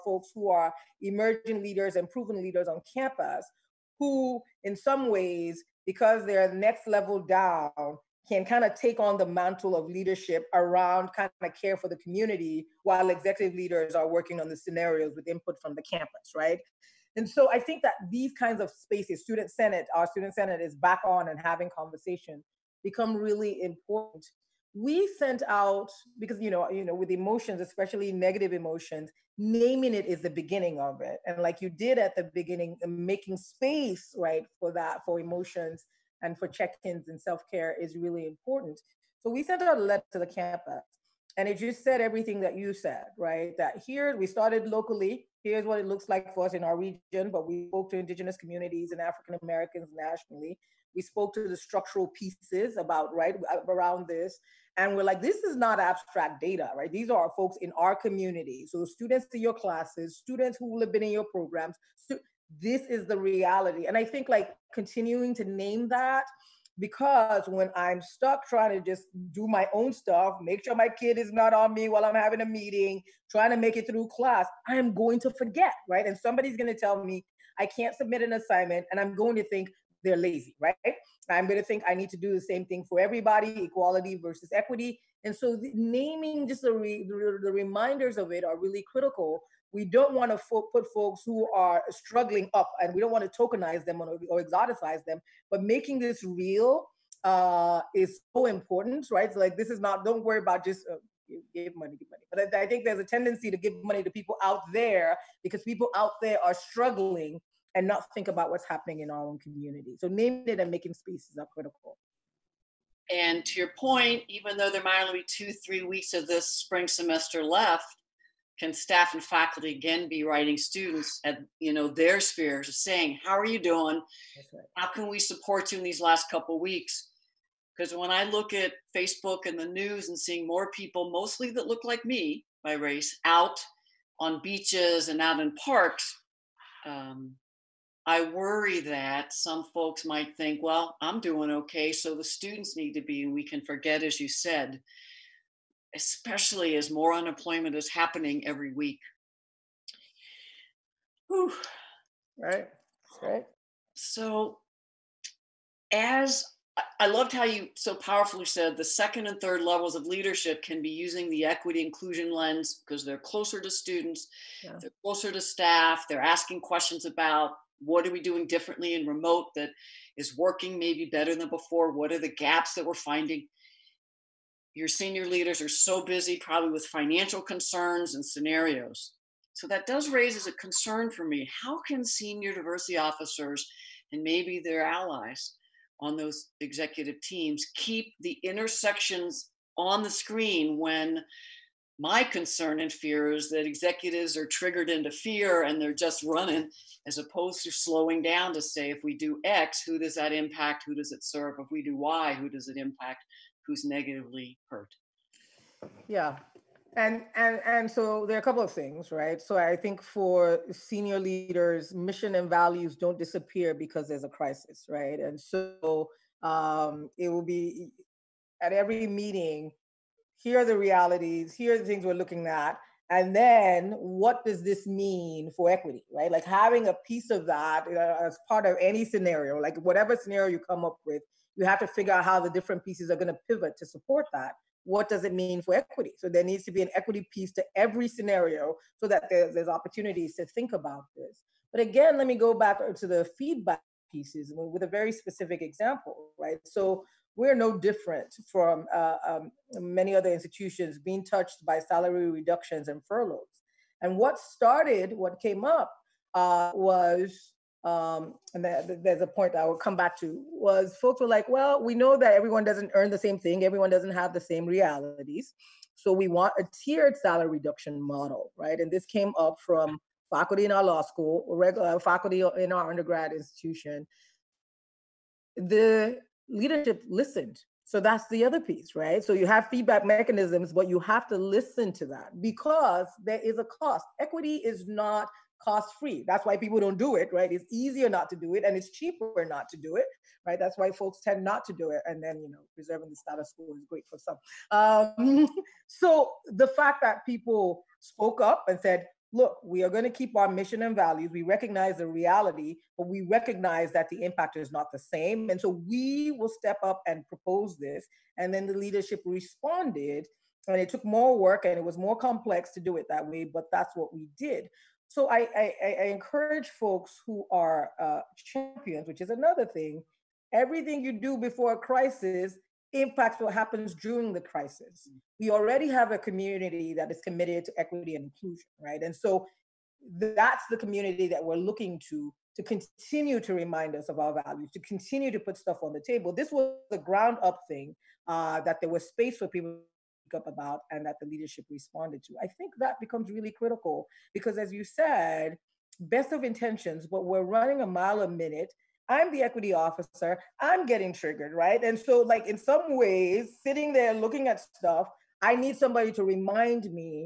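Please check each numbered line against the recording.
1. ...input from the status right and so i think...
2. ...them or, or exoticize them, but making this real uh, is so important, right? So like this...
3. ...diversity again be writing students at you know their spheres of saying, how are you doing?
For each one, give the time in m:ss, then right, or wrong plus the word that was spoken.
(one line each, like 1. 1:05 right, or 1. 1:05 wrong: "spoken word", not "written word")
1. 0:15 wrong: "campus", not "status"
2. 1:33 right
3. 1:59 wrong: "faculty", not "diversity".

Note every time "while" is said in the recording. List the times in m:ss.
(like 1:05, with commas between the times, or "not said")
0:12, 1:11.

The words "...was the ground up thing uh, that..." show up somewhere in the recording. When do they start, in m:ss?
5:36.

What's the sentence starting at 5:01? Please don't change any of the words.
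We recognize the reality, but we recognize that the impact is not the same.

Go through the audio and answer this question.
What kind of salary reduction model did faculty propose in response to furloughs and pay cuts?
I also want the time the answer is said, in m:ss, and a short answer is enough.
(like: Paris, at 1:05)
Tiered, at 4:26.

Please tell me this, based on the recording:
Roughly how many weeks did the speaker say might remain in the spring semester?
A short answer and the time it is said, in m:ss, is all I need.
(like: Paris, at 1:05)
two, three weeks, at 1:55.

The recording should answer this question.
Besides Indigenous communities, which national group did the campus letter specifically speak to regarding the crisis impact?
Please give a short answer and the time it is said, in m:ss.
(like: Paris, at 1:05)
African Americans, at 0:49.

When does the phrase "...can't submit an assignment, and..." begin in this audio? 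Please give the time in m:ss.
1:17.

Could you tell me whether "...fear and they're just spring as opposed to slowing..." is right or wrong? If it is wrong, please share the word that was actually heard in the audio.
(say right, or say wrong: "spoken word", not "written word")
wrong: "running", not "spring".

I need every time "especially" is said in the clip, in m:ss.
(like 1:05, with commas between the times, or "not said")
0:27, 2:25.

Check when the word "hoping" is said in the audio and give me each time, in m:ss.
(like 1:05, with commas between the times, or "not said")
not said.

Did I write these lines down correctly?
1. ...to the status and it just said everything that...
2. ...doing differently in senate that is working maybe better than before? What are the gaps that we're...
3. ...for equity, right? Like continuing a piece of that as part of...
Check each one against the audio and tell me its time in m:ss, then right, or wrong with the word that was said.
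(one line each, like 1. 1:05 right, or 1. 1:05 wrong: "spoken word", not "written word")
1. 0:40 wrong: "campus", not "status"
2. 2:48 wrong: "remote", not "senate"
3. 3:45 wrong: "having", not "continuing".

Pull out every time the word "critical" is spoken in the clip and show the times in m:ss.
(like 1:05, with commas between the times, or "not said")
1:28, 1:51, 5:43.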